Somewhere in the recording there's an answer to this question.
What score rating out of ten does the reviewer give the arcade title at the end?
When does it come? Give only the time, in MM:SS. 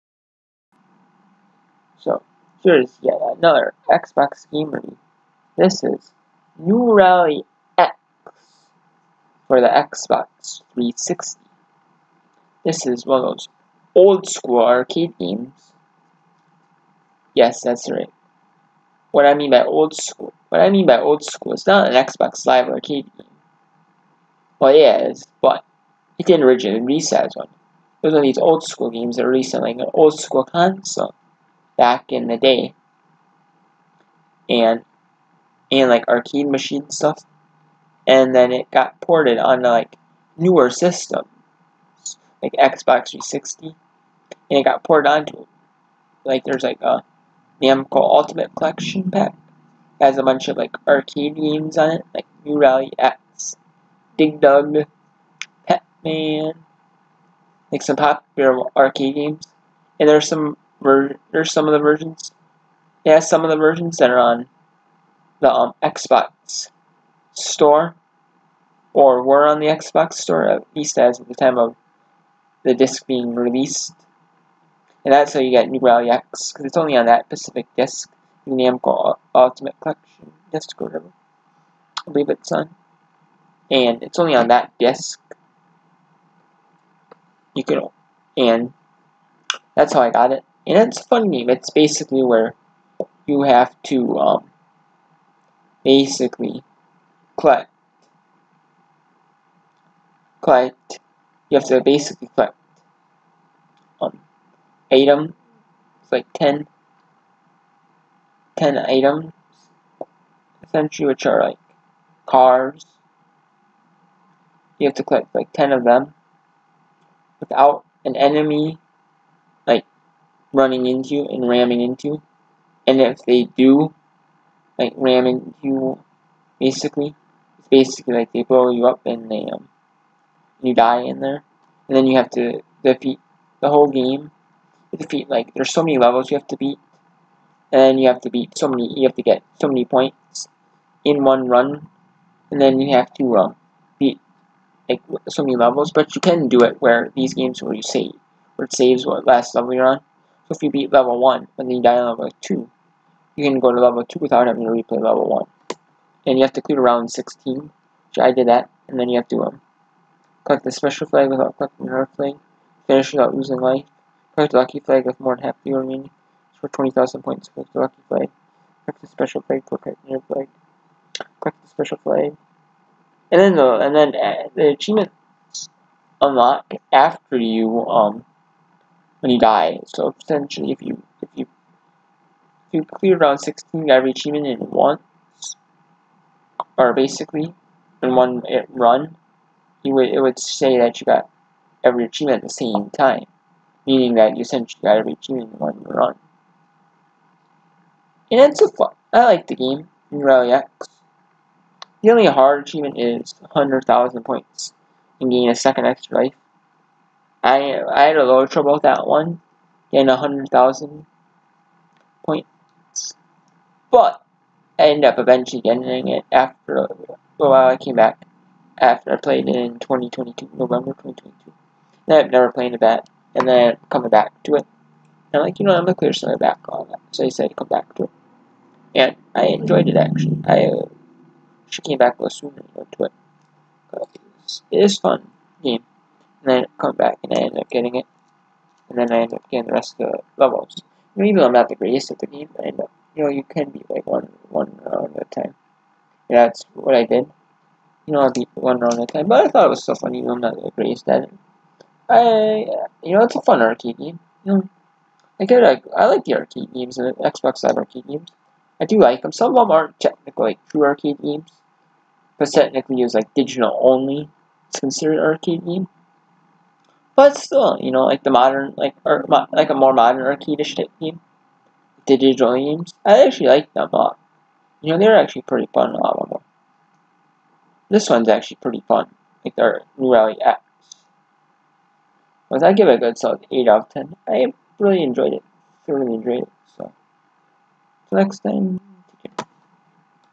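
04:43.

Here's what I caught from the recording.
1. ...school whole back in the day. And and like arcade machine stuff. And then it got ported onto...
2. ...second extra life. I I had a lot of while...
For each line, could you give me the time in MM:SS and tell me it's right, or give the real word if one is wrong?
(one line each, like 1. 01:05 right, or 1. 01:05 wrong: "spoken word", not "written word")
1. 00:30 wrong: "console", not "whole"
2. 03:25 wrong: "trouble", not "while".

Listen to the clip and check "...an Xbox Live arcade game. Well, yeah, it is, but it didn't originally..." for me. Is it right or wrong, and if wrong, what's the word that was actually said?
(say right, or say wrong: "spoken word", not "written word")
right.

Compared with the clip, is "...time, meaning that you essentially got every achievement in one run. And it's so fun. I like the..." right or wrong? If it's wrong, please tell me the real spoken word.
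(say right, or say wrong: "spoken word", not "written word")
right.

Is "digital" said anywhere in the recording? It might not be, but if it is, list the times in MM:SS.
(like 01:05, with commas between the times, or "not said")
04:23, 04:32.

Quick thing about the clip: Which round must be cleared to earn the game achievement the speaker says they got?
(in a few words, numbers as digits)
16.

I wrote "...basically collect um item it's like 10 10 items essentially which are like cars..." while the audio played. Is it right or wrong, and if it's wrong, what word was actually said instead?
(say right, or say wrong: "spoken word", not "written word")
right.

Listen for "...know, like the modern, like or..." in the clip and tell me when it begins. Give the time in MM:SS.
04:27.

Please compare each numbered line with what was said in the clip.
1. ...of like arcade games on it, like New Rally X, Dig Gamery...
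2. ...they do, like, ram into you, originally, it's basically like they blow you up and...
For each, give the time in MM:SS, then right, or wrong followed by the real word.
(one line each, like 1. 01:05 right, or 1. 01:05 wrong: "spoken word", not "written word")
1. 00:50 wrong: "Dug", not "Gamery"
2. 02:03 wrong: "basically", not "originally".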